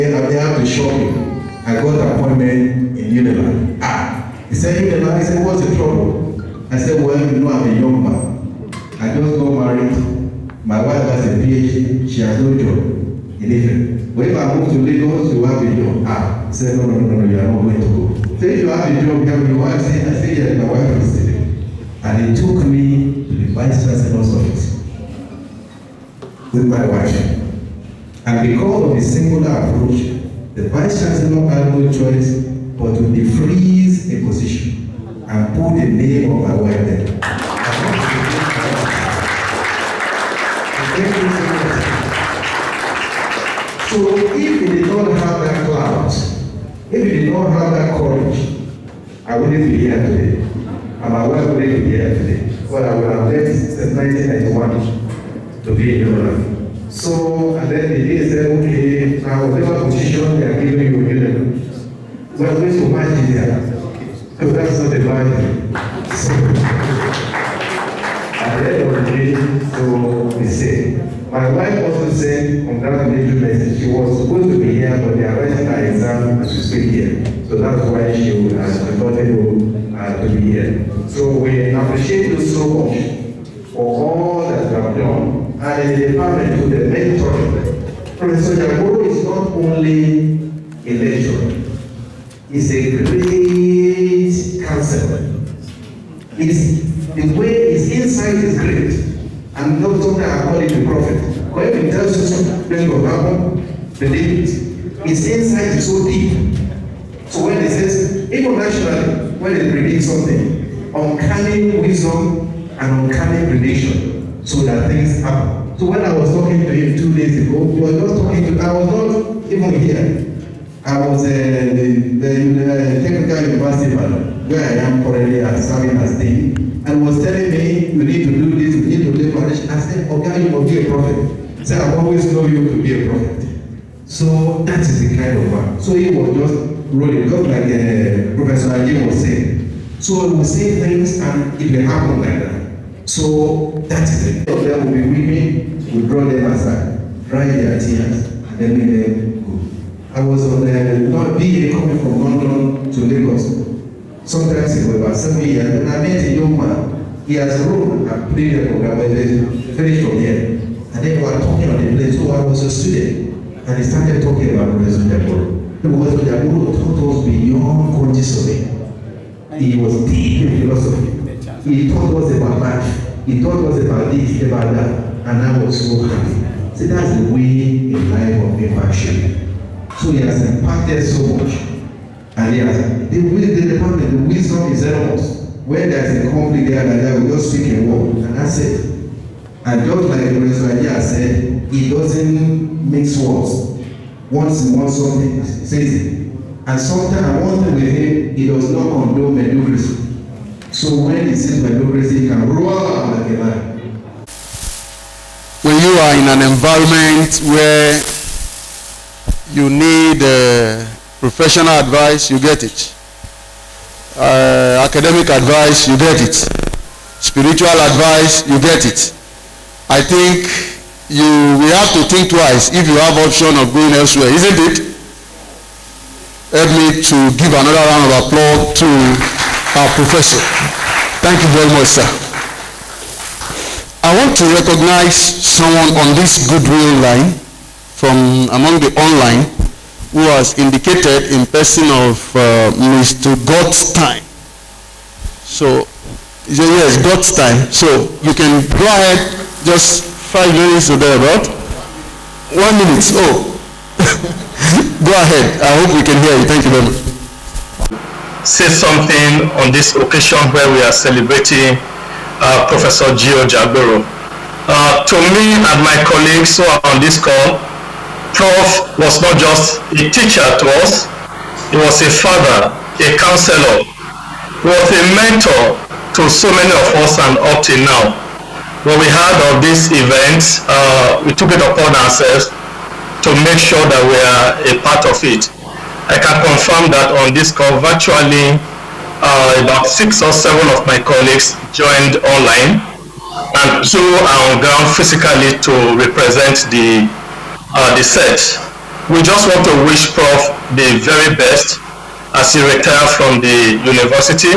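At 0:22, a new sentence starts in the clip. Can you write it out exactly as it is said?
And he took me to the vice chancellor's office with my wife.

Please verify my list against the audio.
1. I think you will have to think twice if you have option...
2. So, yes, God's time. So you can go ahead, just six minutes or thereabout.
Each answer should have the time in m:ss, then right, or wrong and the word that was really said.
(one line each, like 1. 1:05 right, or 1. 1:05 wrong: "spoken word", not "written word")
1. 3:39 right
2. 4:05 wrong: "five", not "six".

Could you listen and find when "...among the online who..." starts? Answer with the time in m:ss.
3:58.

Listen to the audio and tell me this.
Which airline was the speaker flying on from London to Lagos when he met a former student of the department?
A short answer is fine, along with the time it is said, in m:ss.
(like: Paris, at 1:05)
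BA, at 2:31.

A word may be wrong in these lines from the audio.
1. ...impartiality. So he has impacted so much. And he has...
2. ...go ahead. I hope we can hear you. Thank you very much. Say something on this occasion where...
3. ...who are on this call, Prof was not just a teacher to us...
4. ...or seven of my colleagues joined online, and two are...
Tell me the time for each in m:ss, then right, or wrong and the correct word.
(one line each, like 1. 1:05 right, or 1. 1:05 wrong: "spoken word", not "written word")
1. 2:58 right
2. 4:15 right
3. 4:26 right
4. 4:50 right.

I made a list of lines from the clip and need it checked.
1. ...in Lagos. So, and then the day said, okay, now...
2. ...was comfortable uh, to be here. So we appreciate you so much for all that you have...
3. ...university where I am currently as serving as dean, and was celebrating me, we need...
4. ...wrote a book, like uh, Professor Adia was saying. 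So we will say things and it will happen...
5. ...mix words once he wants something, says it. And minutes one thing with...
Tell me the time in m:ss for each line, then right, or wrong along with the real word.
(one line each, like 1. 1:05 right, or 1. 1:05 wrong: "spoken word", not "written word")
1. 0:56 wrong: "Ireland", not "Lagos"
2. 1:18 right
3. 2:03 wrong: "telling", not "celebrating"
4. 2:16 wrong: "Ajayi", not "Adia"
5. 3:12 wrong: "sometimes", not "minutes".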